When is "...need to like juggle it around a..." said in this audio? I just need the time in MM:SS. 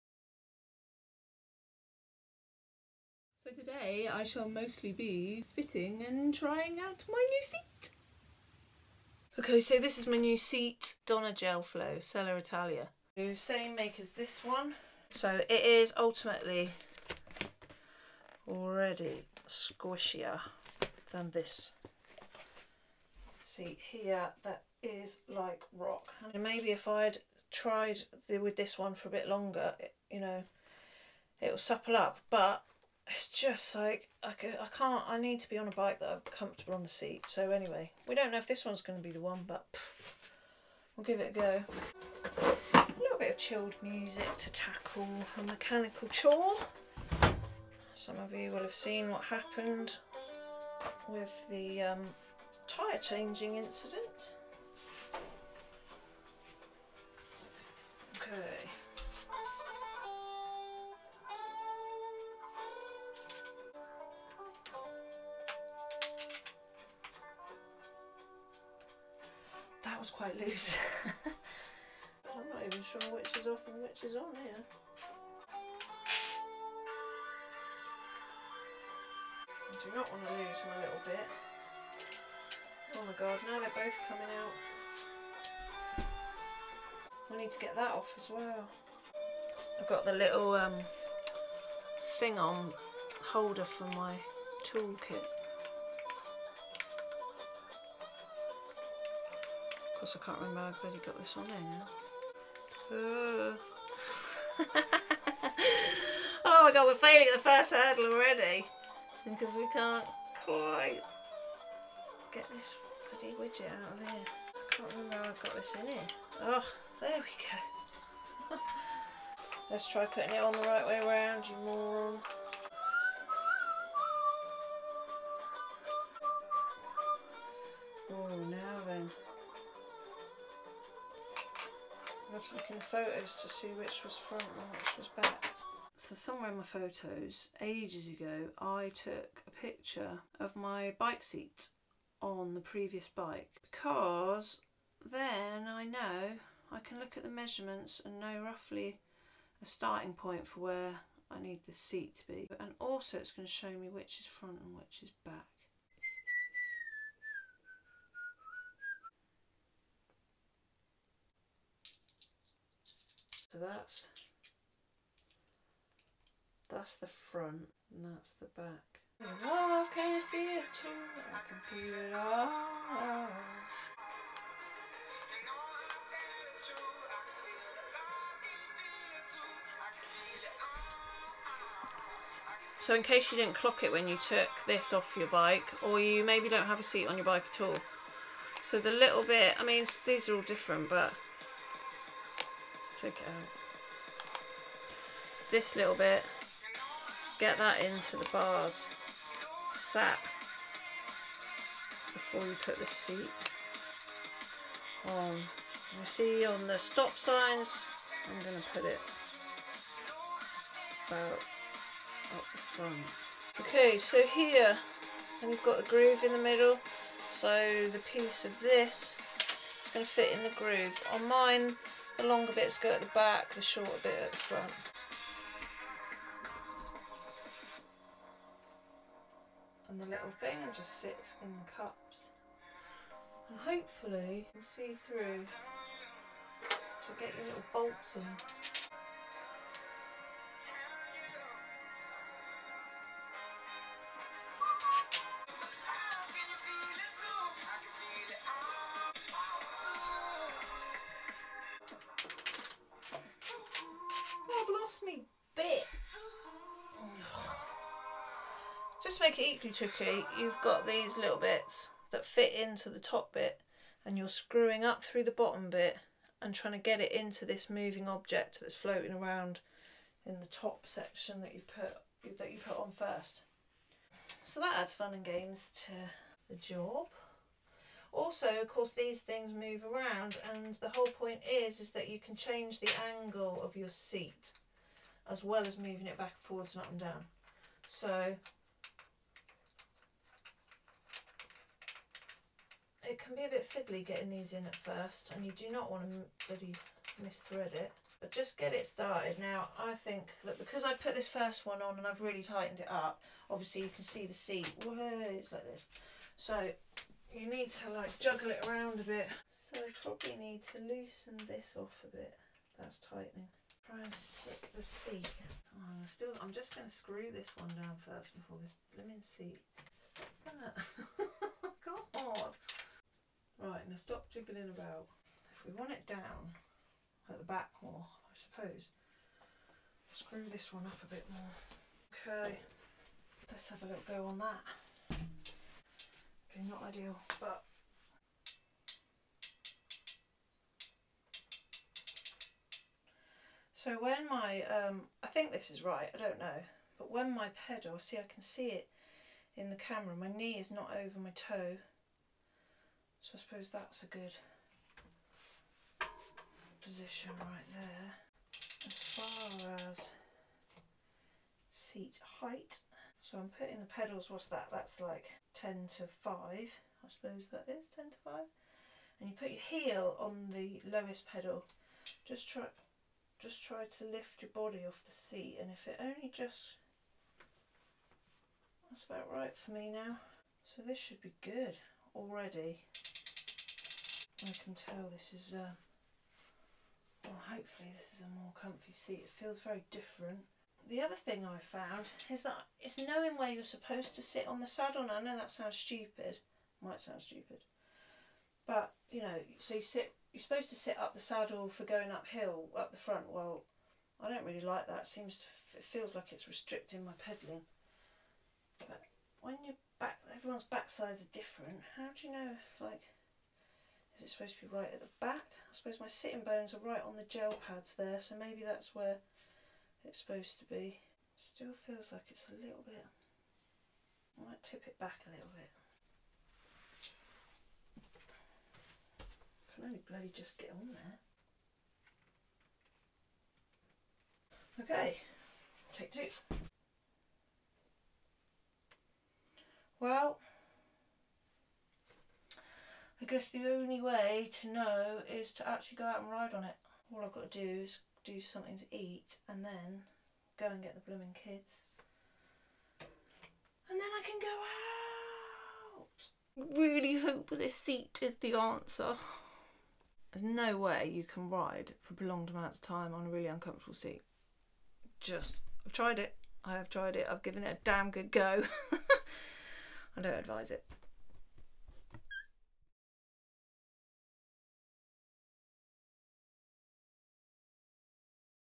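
05:07.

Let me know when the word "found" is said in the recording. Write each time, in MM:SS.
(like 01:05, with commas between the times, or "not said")
06:31.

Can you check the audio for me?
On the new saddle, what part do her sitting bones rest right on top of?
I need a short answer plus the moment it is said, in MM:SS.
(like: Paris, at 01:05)
The gel pads, at 06:57.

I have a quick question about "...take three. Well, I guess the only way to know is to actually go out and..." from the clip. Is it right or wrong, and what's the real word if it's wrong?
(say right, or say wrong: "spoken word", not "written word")
wrong: "two", not "three".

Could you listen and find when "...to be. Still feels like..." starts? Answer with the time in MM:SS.
07:00.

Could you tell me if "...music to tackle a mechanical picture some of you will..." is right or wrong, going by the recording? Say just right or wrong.
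wrong.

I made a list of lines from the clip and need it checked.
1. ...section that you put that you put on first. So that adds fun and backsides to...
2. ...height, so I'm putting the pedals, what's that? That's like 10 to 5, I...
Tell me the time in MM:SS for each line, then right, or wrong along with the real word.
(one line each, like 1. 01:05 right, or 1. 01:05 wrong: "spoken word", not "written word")
1. 04:30 wrong: "games", not "backsides"
2. 06:02 right.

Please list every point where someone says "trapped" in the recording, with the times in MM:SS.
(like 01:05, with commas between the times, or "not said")
not said.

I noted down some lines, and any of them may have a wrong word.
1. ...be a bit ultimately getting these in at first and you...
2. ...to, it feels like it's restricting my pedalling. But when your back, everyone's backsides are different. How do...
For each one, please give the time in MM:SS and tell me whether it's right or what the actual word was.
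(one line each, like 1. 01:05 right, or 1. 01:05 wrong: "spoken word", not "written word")
1. 04:53 wrong: "fiddly", not "ultimately"
2. 06:45 right.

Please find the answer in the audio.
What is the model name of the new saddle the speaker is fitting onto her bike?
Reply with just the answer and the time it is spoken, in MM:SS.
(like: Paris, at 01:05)
Donna Gel Flow, at 00:11.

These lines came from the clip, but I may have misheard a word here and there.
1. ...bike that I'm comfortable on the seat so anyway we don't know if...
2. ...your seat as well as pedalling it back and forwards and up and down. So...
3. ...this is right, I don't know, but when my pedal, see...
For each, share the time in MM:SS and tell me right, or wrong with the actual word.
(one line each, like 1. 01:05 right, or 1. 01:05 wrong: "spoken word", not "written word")
1. 00:35 right
2. 04:43 wrong: "moving", not "pedalling"
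3. 05:45 right.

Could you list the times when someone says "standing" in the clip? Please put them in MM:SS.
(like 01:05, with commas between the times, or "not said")
not said.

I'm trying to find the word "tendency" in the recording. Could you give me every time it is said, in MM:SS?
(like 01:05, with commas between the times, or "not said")
not said.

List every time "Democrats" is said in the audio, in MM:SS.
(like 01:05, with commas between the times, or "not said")
not said.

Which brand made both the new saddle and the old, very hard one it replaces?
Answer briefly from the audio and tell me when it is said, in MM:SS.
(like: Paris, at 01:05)
Selle Italia, at 00:11.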